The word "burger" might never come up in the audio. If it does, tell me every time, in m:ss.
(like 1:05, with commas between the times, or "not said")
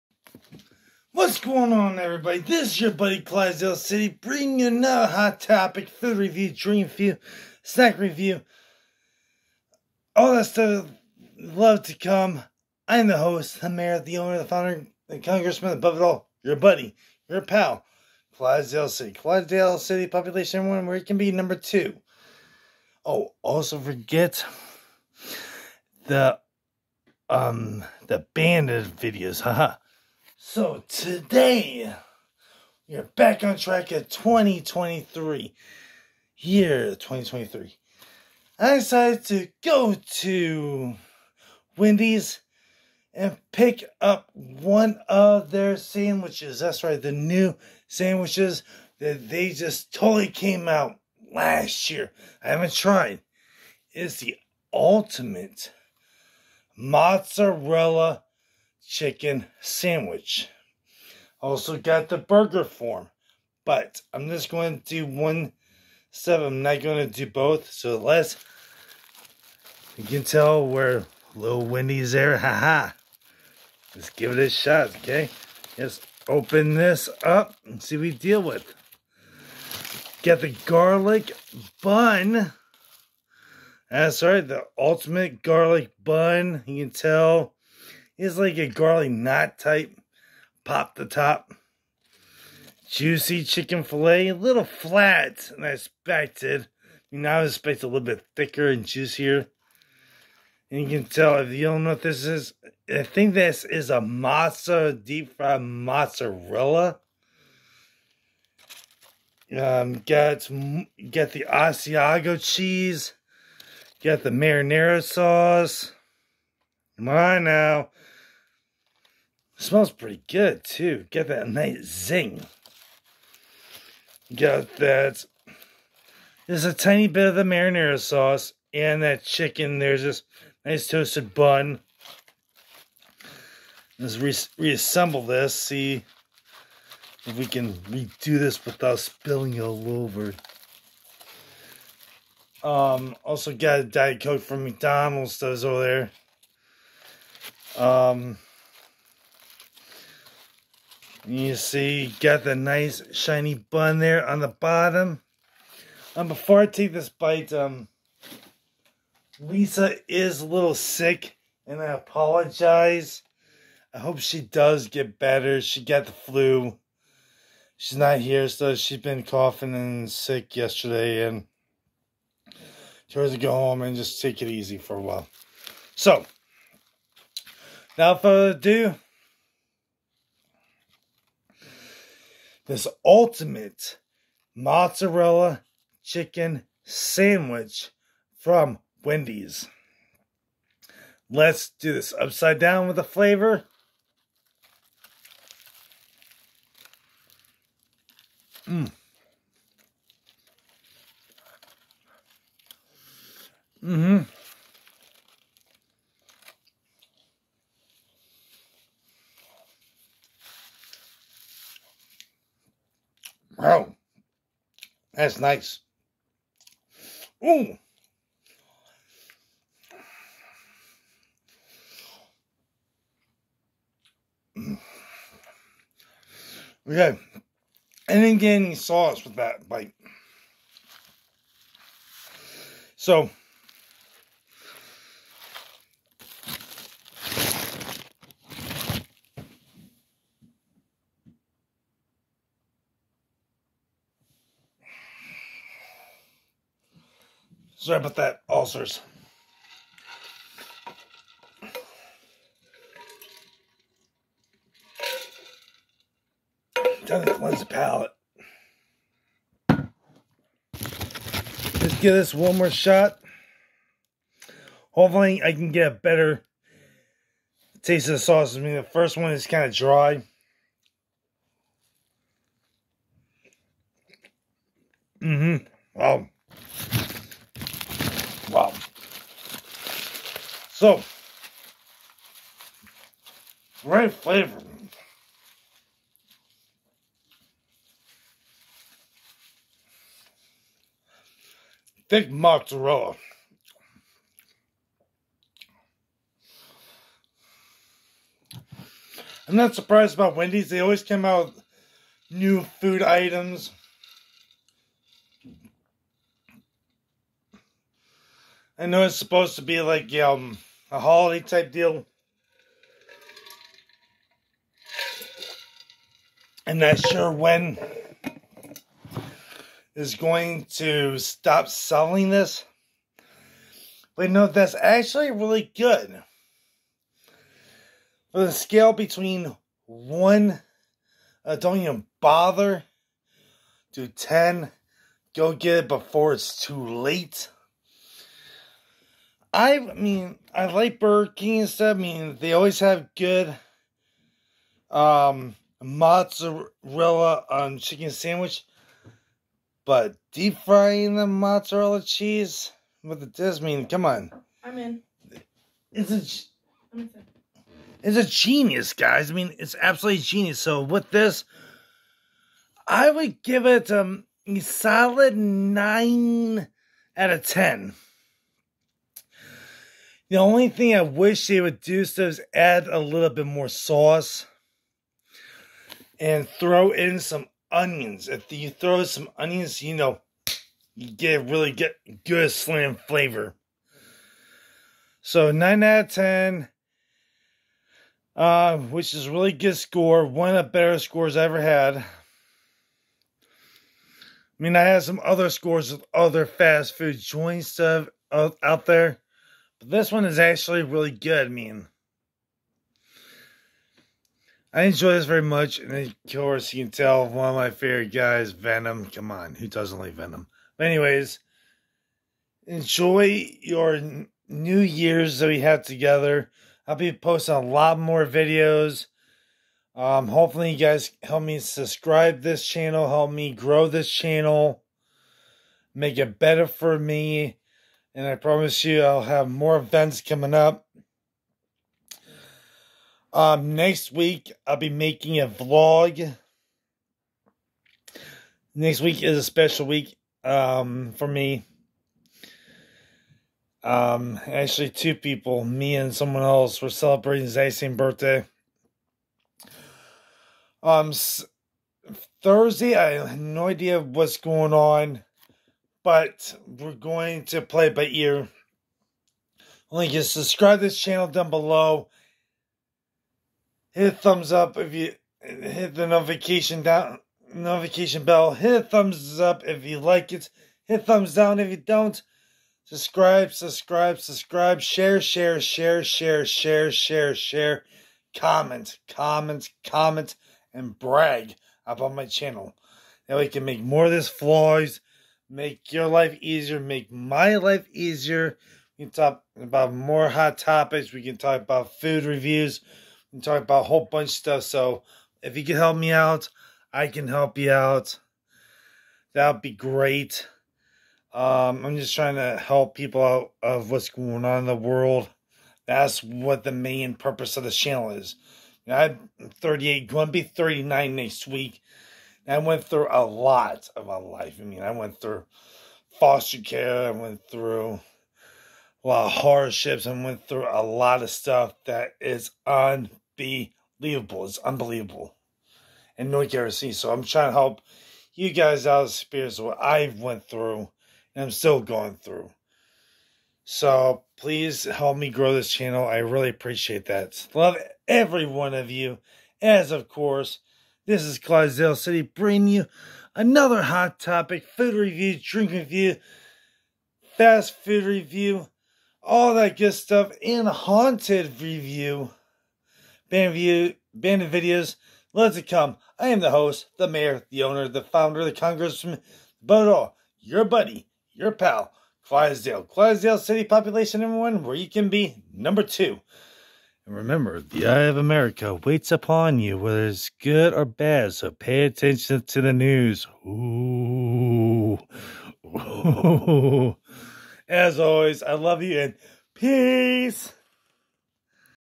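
1:02, 5:40.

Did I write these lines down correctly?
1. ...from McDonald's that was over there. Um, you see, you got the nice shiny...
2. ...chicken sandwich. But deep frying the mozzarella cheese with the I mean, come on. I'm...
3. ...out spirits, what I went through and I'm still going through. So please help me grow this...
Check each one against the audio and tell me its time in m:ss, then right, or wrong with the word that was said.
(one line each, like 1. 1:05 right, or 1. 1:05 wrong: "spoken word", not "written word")
1. 2:24 right
2. 5:47 right
3. 8:48 right.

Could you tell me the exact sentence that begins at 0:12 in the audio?
I'm the host, the mayor, the owner, the founder, the congressman, above it all, your buddy, your pal, Clydesdale City.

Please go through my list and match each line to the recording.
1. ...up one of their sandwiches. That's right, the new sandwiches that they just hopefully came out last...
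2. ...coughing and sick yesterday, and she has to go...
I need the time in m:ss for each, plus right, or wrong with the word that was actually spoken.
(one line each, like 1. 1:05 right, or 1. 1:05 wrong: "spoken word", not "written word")
1. 0:44 wrong: "totally", not "hopefully"
2. 2:49 right.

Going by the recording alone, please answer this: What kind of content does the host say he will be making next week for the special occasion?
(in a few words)
A vlog.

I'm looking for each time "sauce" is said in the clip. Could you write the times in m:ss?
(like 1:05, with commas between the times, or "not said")
1:55, 2:07, 3:48, 4:28, 6:13.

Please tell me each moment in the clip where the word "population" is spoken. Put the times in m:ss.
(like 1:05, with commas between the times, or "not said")
0:20, 9:23.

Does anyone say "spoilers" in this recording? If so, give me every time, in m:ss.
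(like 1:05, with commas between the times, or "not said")
not said.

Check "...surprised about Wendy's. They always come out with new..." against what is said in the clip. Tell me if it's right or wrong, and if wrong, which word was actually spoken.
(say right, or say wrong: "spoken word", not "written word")
right.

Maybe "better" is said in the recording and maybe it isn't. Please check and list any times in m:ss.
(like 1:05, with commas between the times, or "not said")
2:45, 4:25, 6:30, 7:06.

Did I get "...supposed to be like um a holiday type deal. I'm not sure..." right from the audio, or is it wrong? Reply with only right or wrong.
right.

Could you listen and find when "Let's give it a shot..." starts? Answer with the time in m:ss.
1:13.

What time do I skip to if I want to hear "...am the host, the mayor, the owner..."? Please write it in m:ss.
9:16.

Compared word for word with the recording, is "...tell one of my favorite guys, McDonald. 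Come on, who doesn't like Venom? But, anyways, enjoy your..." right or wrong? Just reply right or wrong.
wrong.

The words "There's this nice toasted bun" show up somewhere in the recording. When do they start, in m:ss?
2:09.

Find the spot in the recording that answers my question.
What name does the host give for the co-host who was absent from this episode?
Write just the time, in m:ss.
2:39.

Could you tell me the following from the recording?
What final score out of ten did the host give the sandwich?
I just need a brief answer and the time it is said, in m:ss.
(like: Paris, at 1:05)
9, at 6:05.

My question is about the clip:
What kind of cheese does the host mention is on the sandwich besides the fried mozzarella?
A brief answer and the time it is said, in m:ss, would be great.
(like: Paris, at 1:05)
Asiago, at 1:51.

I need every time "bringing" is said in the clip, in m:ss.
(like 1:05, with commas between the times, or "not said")
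0:04, 9:02.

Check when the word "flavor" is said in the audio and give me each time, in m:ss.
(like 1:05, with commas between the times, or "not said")
3:13, 4:44, 6:22.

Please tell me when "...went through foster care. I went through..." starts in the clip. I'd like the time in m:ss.
8:34.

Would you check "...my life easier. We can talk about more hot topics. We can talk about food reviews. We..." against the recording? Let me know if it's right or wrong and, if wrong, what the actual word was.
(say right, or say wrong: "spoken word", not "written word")
right.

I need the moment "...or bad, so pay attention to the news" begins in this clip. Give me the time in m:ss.
9:30.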